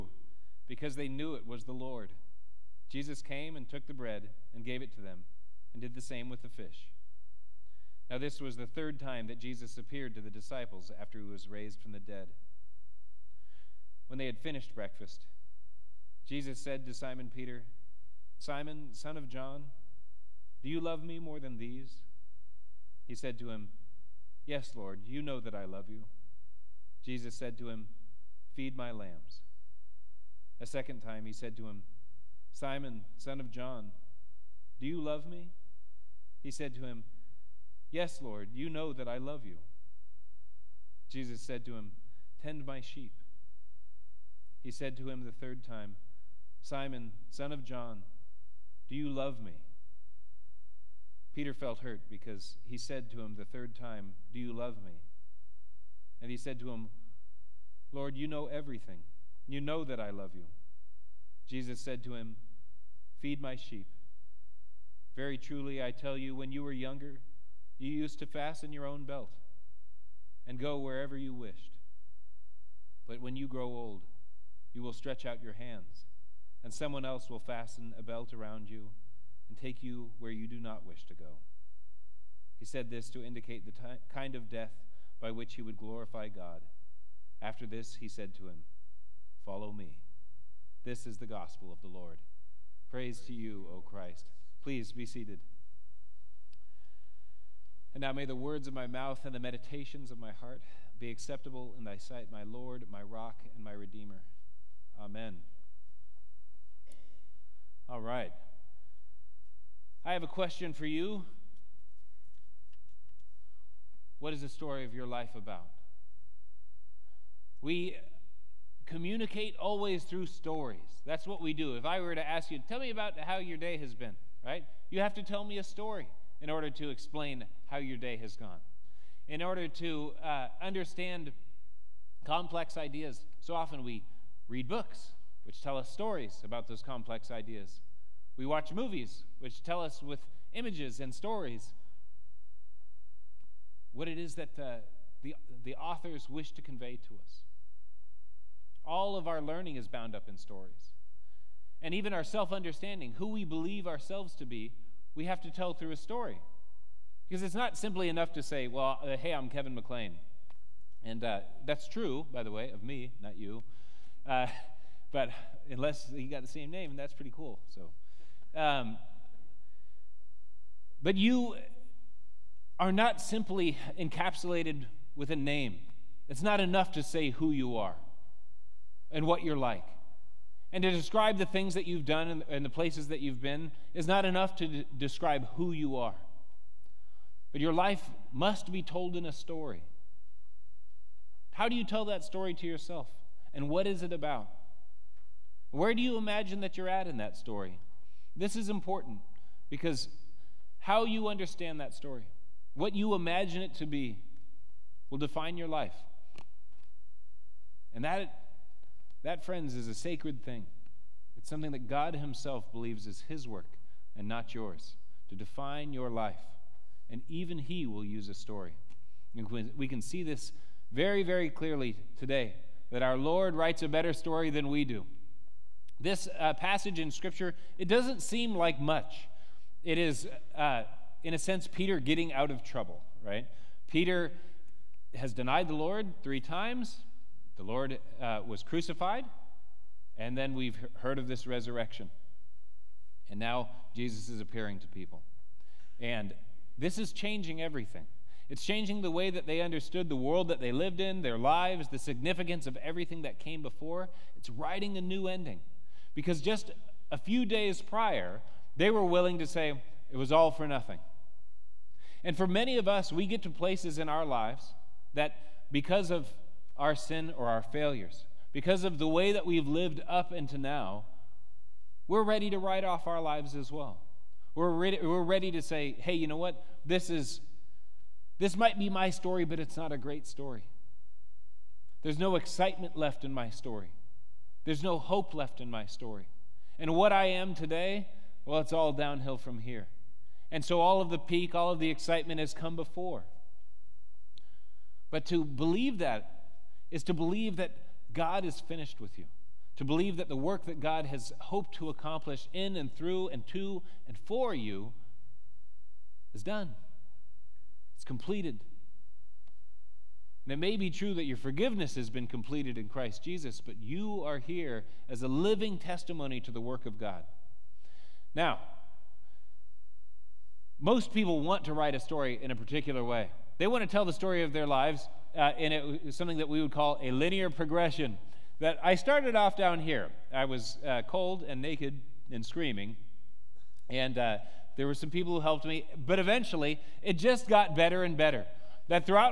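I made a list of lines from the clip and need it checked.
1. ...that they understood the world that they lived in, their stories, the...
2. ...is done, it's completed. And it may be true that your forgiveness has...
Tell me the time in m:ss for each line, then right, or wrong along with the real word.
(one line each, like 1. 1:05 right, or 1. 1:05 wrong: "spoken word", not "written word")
1. 4:09 wrong: "lives", not "stories"
2. 5:06 right.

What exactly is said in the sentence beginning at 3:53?
Peter has denied the Lord three times.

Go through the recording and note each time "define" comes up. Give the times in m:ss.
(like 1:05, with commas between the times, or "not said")
3:25, 3:35.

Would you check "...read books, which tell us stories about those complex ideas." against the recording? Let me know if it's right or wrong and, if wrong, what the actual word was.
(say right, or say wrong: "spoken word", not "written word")
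right.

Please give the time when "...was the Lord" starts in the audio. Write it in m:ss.
0:01.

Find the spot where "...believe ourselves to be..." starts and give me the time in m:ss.
2:33.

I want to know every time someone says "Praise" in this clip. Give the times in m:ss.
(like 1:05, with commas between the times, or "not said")
1:32.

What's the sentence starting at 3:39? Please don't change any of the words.
we can see this very, very clearly today that our Lord writes a better story than we do.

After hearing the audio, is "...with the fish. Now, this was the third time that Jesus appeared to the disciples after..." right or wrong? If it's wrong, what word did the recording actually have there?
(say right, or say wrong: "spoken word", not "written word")
right.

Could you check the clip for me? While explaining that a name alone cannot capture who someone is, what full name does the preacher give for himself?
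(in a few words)
Kevin McClain.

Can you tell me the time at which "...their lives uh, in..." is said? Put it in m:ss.
5:24.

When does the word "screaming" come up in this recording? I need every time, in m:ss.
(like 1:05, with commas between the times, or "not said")
5:32.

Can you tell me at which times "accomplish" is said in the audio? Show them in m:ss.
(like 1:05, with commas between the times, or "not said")
5:01.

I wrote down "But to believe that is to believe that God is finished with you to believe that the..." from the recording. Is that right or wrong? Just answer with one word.
right.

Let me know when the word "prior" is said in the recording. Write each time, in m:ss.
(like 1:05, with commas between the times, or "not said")
4:17.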